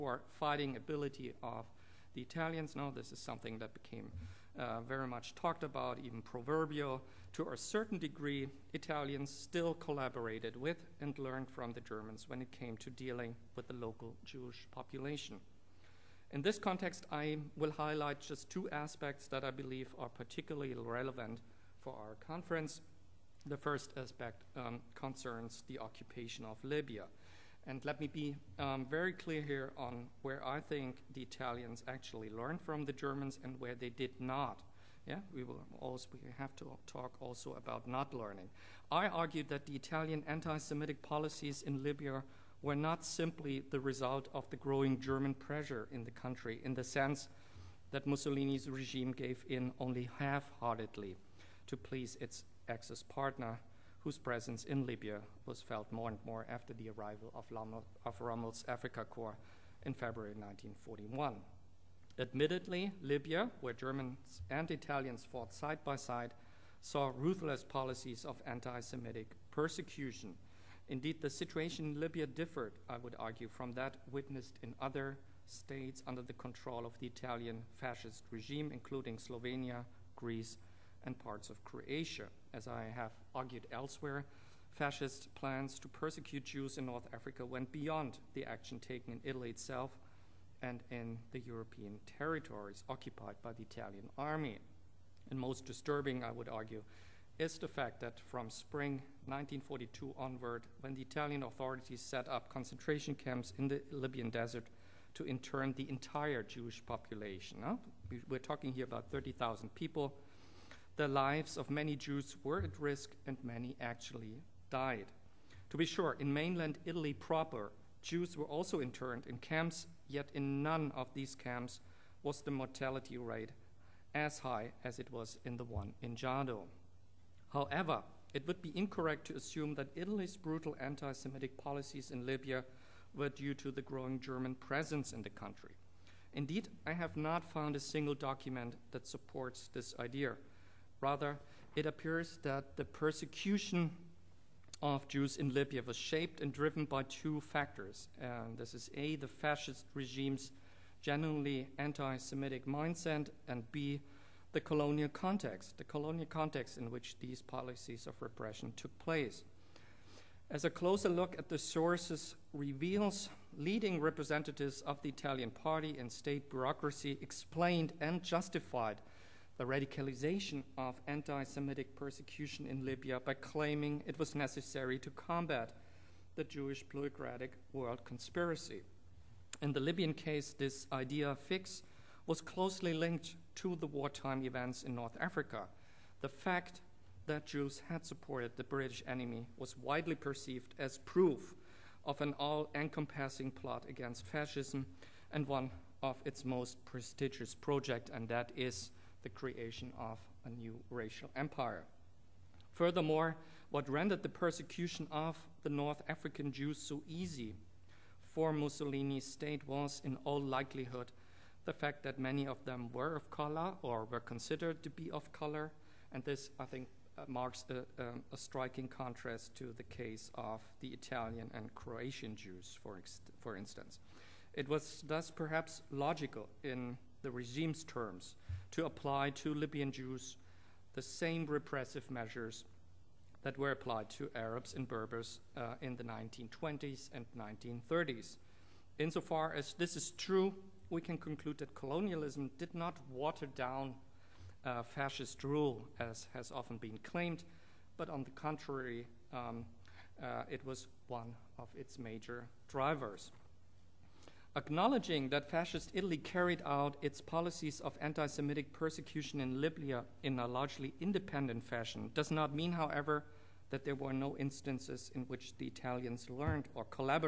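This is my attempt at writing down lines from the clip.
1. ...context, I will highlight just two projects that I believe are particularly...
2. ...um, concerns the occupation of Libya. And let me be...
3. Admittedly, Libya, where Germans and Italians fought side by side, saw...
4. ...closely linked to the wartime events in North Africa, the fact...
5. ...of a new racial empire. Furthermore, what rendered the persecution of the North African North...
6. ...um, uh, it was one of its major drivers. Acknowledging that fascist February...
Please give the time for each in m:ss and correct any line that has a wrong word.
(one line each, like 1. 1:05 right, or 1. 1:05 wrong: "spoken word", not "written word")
1. 0:16 wrong: "aspects", not "projects"
2. 0:24 right
3. 1:02 right
4. 3:02 right
5. 3:19 wrong: "Jews", not "North"
6. 4:09 wrong: "Italy", not "February".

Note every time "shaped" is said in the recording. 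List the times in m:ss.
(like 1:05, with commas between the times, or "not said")
2:25.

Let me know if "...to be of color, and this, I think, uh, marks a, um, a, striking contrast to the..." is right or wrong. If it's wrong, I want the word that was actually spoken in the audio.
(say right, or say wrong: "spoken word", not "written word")
right.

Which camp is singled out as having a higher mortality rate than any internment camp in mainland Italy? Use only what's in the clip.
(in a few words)
Jado.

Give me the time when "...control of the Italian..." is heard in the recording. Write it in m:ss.
1:16.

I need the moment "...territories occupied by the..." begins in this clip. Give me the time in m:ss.
1:32.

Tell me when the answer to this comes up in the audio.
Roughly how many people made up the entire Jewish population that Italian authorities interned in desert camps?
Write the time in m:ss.
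1:49.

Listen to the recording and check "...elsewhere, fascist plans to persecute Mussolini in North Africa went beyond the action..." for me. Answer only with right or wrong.
wrong.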